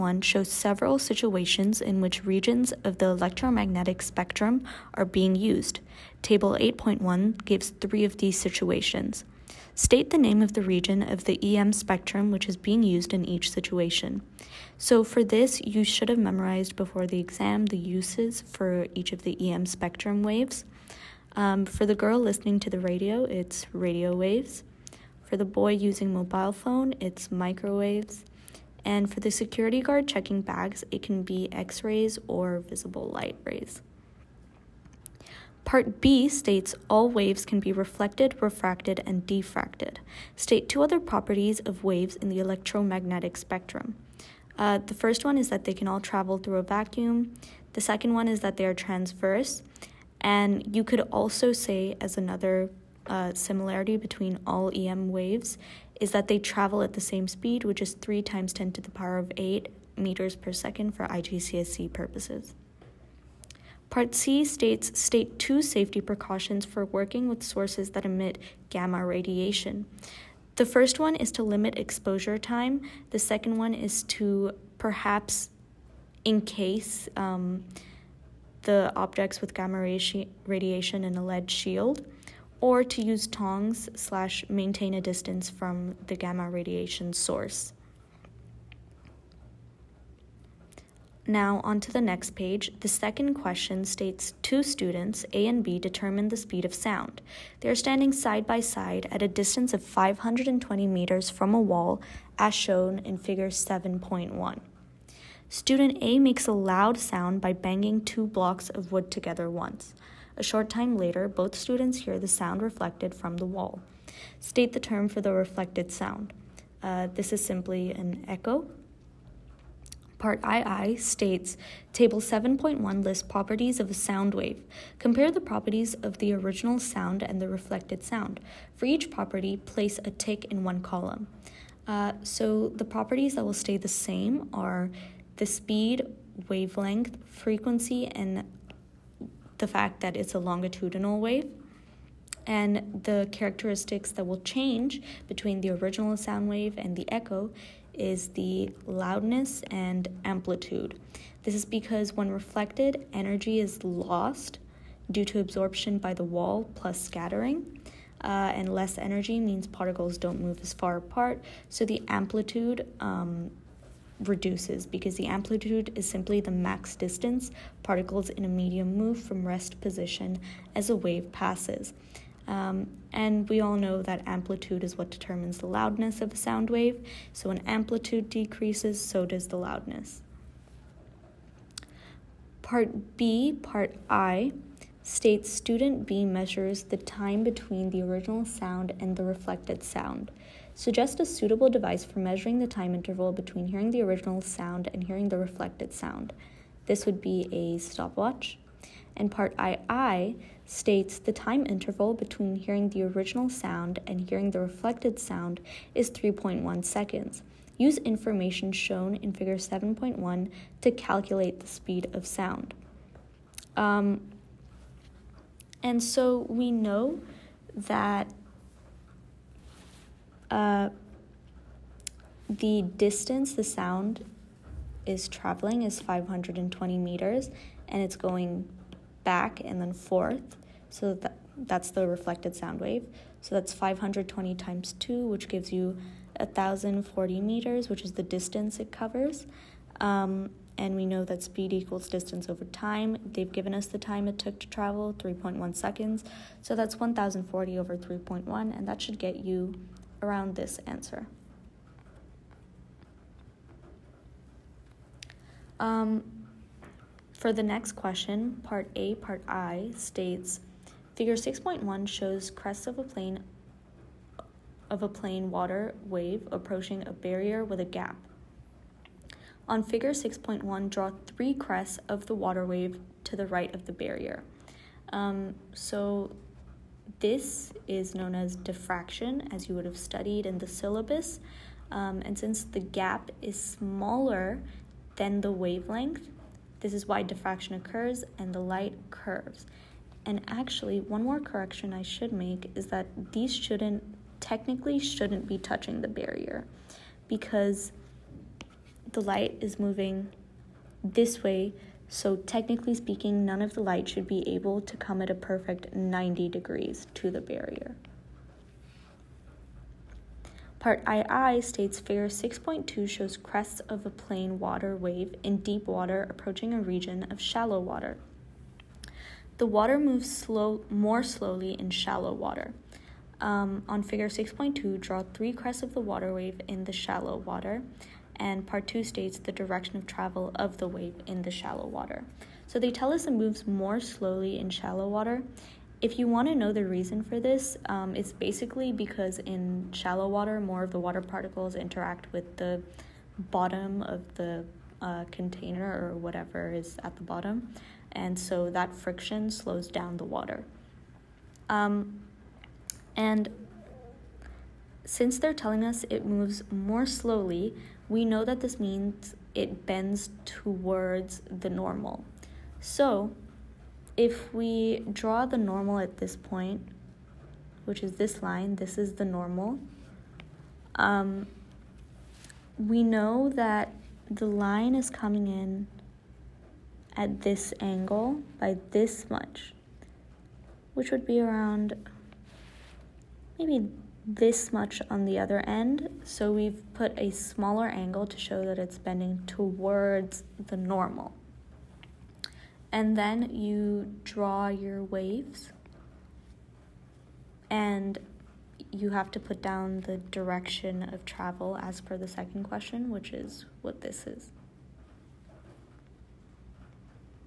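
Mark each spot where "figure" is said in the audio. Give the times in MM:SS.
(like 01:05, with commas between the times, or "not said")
01:43, 03:29, 04:21, 04:29, 05:12, 05:24.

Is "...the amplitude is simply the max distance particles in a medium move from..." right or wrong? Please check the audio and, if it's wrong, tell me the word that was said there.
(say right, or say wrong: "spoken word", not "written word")
right.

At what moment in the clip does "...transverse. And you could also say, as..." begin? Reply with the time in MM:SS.
00:48.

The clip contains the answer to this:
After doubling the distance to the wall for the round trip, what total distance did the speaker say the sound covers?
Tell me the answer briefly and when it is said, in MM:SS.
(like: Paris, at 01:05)
1,040 meters, at 03:56.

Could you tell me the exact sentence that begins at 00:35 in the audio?
Part B states all waves can be reflected, refracted, and diffracted.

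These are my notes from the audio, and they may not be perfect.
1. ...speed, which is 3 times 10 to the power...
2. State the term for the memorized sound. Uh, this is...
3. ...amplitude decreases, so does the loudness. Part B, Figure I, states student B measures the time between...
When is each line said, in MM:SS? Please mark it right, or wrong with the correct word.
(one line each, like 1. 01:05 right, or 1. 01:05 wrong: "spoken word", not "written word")
1. 00:57 right
2. 01:54 wrong: "reflected", not "memorized"
3. 02:57 wrong: "Part", not "Figure".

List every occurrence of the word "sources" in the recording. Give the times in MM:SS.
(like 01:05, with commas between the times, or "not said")
01:07, 01:27.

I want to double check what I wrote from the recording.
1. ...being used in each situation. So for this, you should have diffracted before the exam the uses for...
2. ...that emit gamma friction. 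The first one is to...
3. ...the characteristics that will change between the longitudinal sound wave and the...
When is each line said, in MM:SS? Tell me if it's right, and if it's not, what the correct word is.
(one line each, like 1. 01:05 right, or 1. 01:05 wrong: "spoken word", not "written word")
1. 00:12 wrong: "memorized", not "diffracted"
2. 01:07 wrong: "radiation", not "friction"
3. 02:23 wrong: "original", not "longitudinal".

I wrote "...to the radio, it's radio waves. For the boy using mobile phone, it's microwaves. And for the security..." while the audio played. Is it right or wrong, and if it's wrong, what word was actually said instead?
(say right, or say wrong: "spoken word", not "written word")
right.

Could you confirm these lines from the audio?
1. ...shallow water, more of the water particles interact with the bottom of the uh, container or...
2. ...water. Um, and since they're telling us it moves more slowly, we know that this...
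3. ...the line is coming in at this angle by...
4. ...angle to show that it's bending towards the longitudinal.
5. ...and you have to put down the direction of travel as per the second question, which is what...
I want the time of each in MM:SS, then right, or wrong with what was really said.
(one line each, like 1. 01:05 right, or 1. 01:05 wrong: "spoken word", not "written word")
1. 05:39 right
2. 05:50 right
3. 06:14 right
4. 06:27 wrong: "normal", not "longitudinal"
5. 06:37 right.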